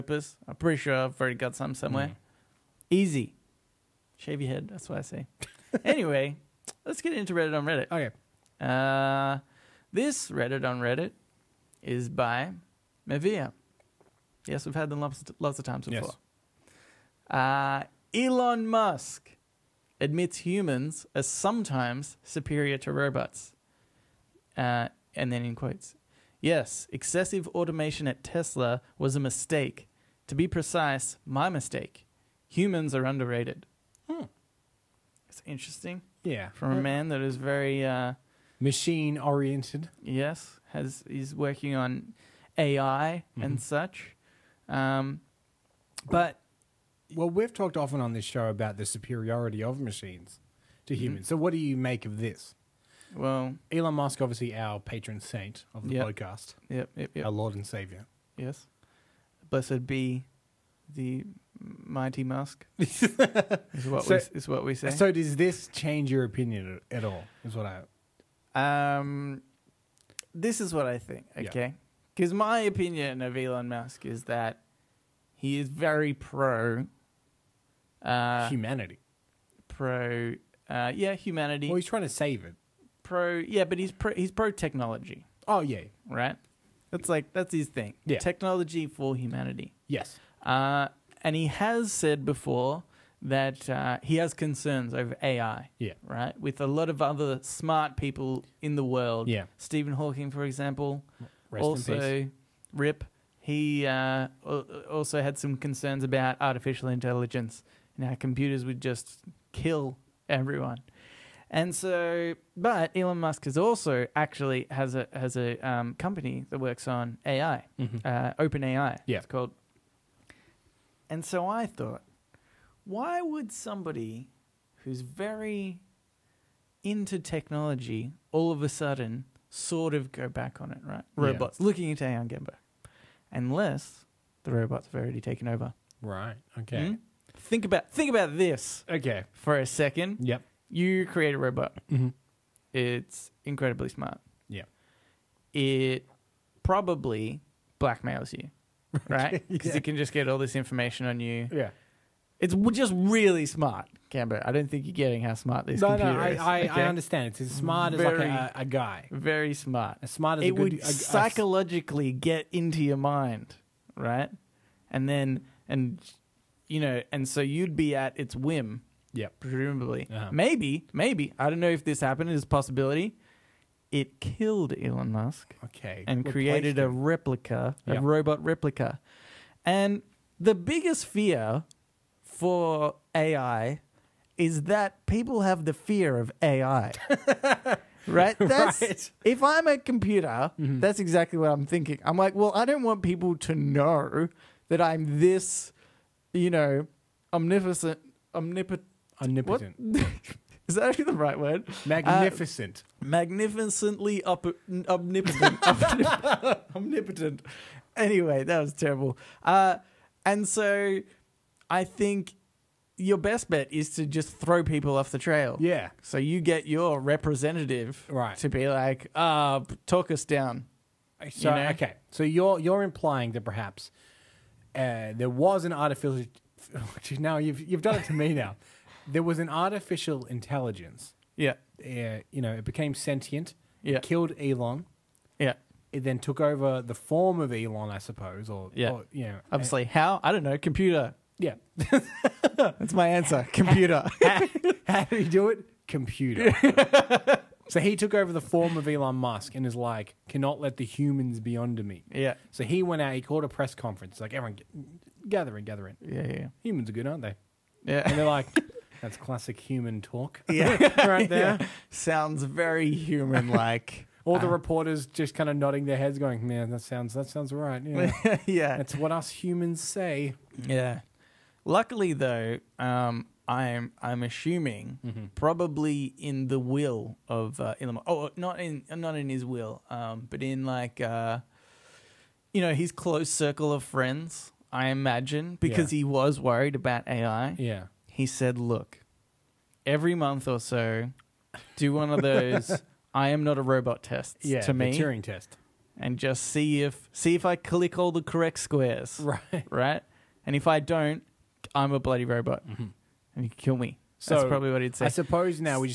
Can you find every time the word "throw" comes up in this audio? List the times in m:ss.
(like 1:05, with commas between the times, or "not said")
3:34.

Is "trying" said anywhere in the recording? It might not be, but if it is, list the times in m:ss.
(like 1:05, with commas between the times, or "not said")
1:21.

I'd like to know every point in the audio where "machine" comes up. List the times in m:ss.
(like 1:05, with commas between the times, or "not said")
0:38, 0:49.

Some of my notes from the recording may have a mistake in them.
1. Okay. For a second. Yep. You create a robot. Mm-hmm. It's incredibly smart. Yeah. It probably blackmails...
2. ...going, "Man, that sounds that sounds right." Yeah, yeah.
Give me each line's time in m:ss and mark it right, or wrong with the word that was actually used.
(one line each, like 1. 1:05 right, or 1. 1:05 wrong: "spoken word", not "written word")
1. 2:18 right
2. 4:26 right.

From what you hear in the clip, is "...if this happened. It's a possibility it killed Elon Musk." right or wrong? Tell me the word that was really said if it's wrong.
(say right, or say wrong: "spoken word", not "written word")
right.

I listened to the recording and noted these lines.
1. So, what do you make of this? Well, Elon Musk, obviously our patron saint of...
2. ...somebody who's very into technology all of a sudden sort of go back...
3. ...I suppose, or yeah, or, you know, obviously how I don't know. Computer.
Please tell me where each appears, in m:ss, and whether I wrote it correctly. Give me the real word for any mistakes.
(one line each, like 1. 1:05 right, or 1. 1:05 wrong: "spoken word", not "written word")
1. 0:51 right
2. 2:03 right
3. 3:57 right.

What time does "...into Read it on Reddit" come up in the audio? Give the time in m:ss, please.
0:07.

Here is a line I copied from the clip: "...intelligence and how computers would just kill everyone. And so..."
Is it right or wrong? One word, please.
right.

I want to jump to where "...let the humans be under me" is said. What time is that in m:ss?
4:10.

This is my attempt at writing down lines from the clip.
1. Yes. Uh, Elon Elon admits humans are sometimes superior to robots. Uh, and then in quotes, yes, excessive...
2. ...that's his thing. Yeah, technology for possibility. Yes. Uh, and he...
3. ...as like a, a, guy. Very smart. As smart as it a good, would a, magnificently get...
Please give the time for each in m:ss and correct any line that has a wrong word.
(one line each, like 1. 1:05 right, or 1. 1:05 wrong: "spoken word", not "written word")
1. 0:17 wrong: "Musk", not "Elon"
2. 1:27 wrong: "humanity", not "possibility"
3. 2:38 wrong: "psychologically", not "magnificently".